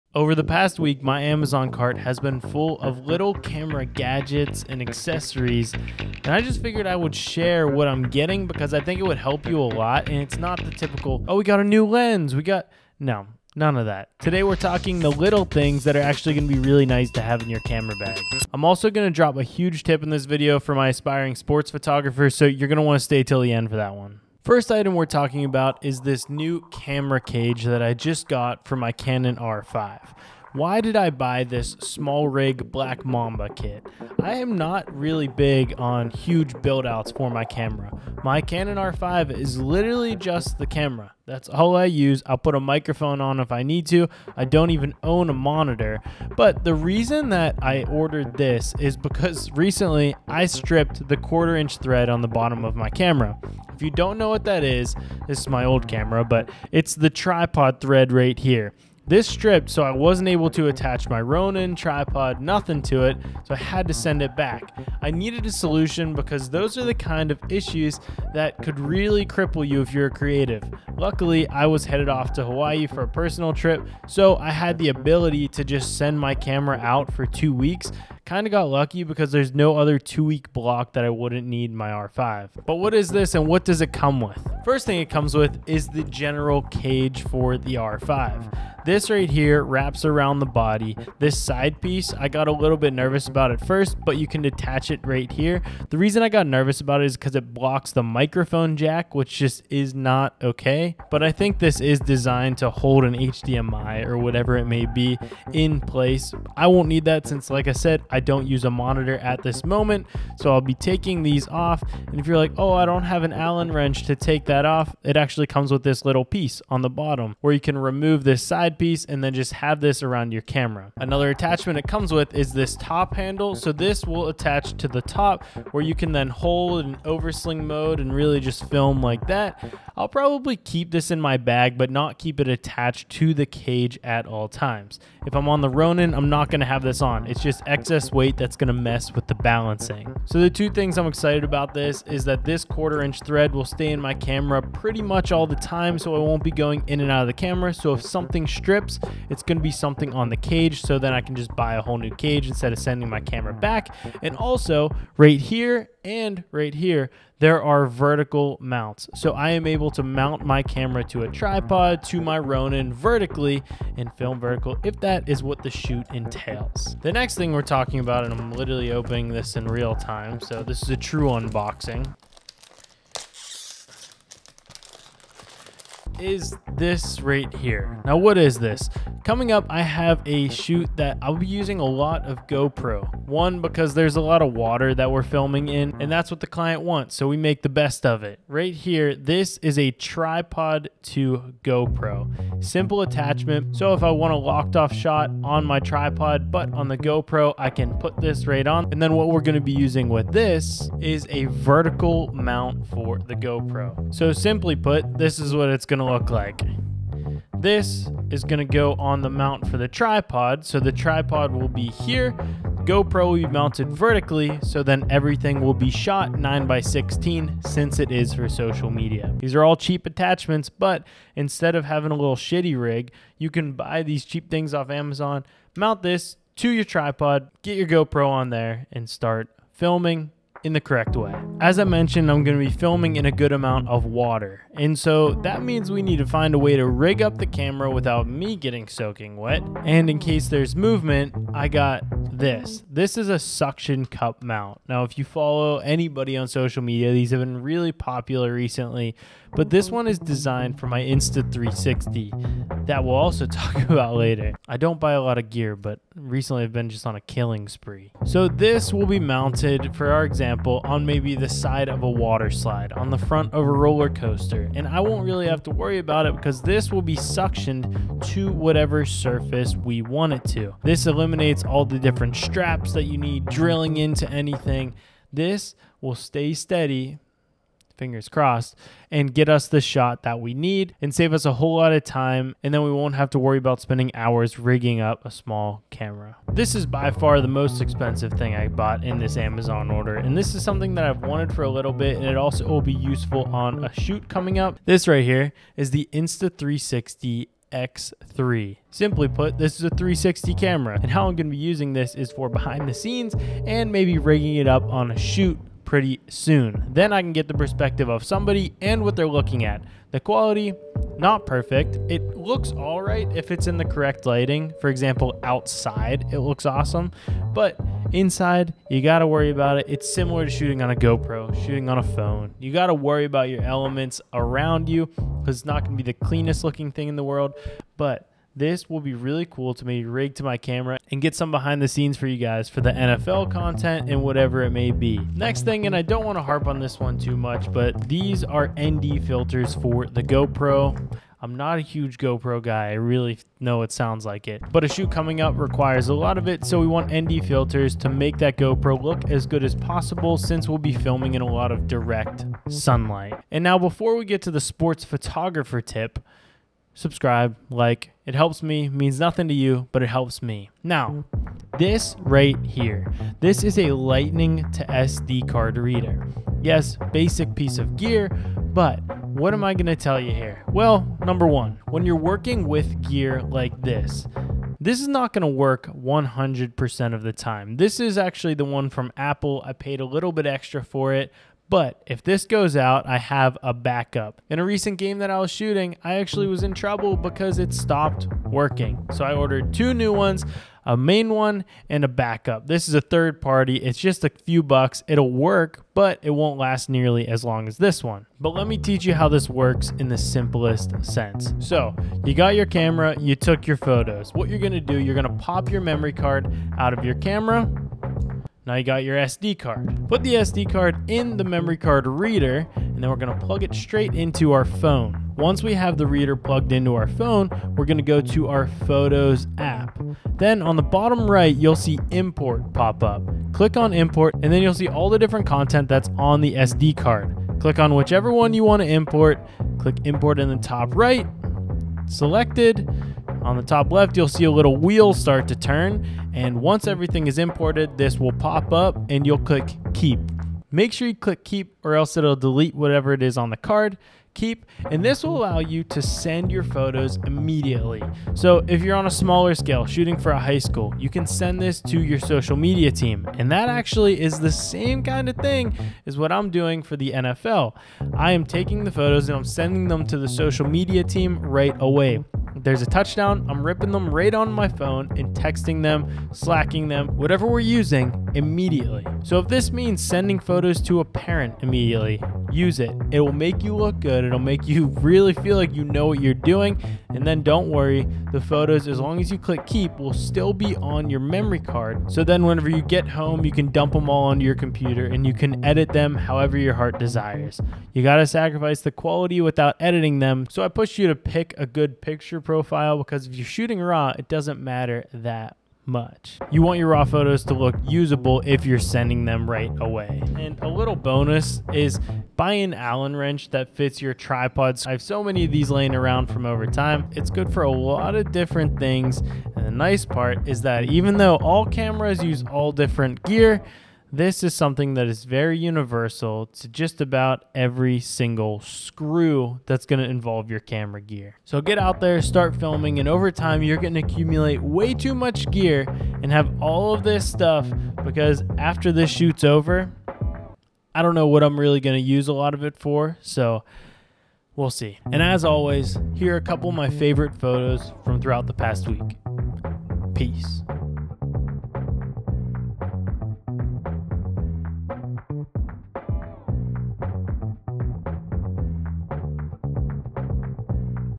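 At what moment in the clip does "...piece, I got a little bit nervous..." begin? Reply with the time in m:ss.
1:31.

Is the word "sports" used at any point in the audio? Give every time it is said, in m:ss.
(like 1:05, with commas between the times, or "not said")
0:21, 5:54.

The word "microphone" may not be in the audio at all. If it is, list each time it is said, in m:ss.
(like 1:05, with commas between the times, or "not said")
0:42, 1:38.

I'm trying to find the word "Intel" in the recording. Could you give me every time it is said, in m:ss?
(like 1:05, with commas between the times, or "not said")
not said.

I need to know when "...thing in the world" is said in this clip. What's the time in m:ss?
5:26.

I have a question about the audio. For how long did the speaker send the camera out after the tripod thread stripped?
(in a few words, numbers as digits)
2 weeks.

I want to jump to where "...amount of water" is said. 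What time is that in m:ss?
3:53.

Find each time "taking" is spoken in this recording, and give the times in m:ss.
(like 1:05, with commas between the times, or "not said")
1:50, 7:38.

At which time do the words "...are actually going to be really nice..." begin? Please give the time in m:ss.
0:15.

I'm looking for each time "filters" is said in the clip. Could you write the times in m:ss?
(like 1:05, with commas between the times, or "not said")
5:39, 5:47.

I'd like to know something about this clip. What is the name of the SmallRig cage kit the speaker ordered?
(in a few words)
Black Mamba.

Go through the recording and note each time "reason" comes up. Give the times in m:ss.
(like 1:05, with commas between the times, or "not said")
0:46, 1:35.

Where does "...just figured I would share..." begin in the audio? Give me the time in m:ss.
0:06.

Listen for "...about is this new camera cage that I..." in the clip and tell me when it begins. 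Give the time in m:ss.
0:25.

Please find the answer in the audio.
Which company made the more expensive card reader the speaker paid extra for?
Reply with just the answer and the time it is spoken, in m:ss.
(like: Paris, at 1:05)
Apple, at 6:19.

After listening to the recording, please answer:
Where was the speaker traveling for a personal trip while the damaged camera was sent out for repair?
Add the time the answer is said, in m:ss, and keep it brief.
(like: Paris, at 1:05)
Hawaii, at 1:12.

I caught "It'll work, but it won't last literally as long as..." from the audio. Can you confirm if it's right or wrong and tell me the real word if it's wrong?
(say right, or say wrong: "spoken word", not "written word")
wrong: "nearly", not "literally".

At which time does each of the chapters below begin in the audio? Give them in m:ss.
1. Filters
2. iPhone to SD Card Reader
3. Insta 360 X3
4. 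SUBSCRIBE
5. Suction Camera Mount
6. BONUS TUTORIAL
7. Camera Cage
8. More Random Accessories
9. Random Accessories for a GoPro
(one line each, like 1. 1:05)
1. 5:36
2. 6:03
3. 4:47
4. 8:50
5. 4:05
6. 6:55
7. 0:27
8. 8:20
9. 2:55.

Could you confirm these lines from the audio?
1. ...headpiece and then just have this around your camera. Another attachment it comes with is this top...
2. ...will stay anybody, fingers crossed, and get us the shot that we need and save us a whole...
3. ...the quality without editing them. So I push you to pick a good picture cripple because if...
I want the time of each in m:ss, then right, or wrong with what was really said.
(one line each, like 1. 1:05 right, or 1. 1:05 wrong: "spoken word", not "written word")
1. 1:58 right
2. 4:36 wrong: "steady", not "anybody"
3. 8:08 wrong: "profile", not "cripple".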